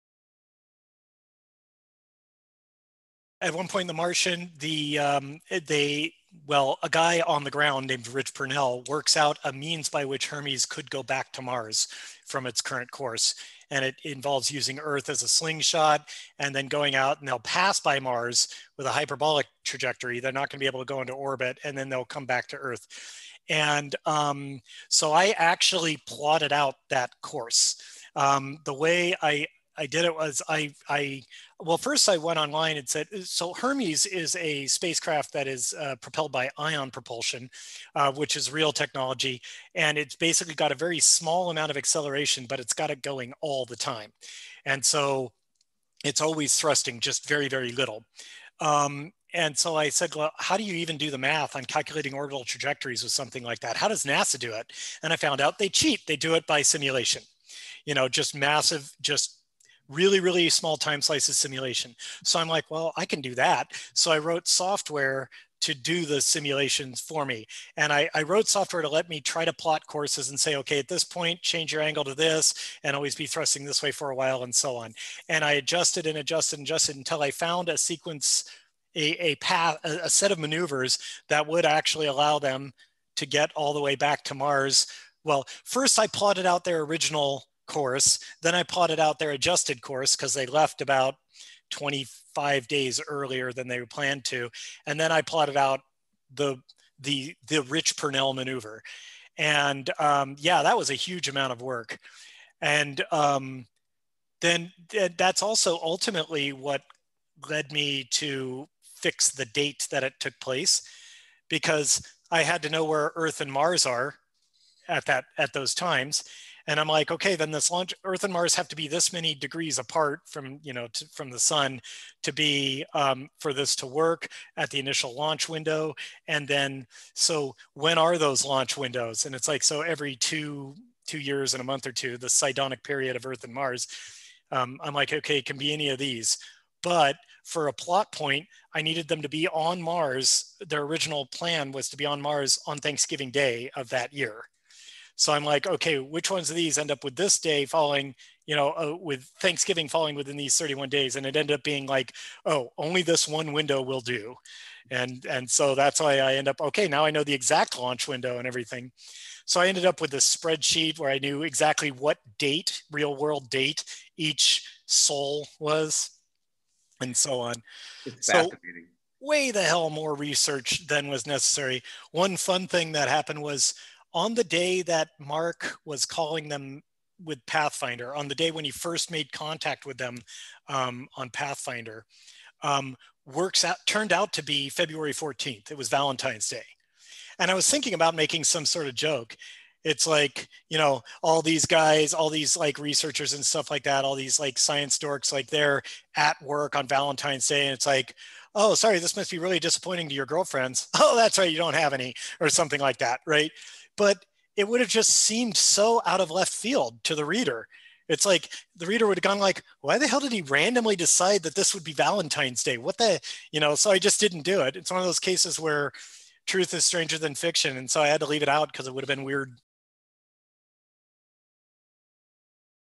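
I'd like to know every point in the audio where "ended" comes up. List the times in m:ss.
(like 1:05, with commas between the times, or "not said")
2:31, 2:39.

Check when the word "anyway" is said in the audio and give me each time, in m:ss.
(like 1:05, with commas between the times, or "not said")
not said.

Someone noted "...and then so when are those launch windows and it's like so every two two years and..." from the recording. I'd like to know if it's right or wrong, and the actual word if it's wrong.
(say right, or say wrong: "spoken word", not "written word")
right.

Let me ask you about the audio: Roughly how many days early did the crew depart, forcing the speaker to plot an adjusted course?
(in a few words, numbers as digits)
25.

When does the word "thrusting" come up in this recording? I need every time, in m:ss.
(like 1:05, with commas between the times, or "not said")
0:46, 1:13.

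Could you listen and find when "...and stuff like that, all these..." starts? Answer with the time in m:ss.
3:13.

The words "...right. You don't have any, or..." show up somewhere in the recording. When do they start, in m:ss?
3:21.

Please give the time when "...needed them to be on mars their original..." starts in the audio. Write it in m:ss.
2:18.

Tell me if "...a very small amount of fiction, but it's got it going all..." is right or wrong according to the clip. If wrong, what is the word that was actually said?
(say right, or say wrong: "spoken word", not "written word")
wrong: "acceleration", not "fiction".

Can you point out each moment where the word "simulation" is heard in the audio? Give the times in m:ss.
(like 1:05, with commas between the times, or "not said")
0:56, 1:01, 1:06.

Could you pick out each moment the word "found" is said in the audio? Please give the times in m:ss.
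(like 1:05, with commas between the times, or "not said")
0:55, 1:17.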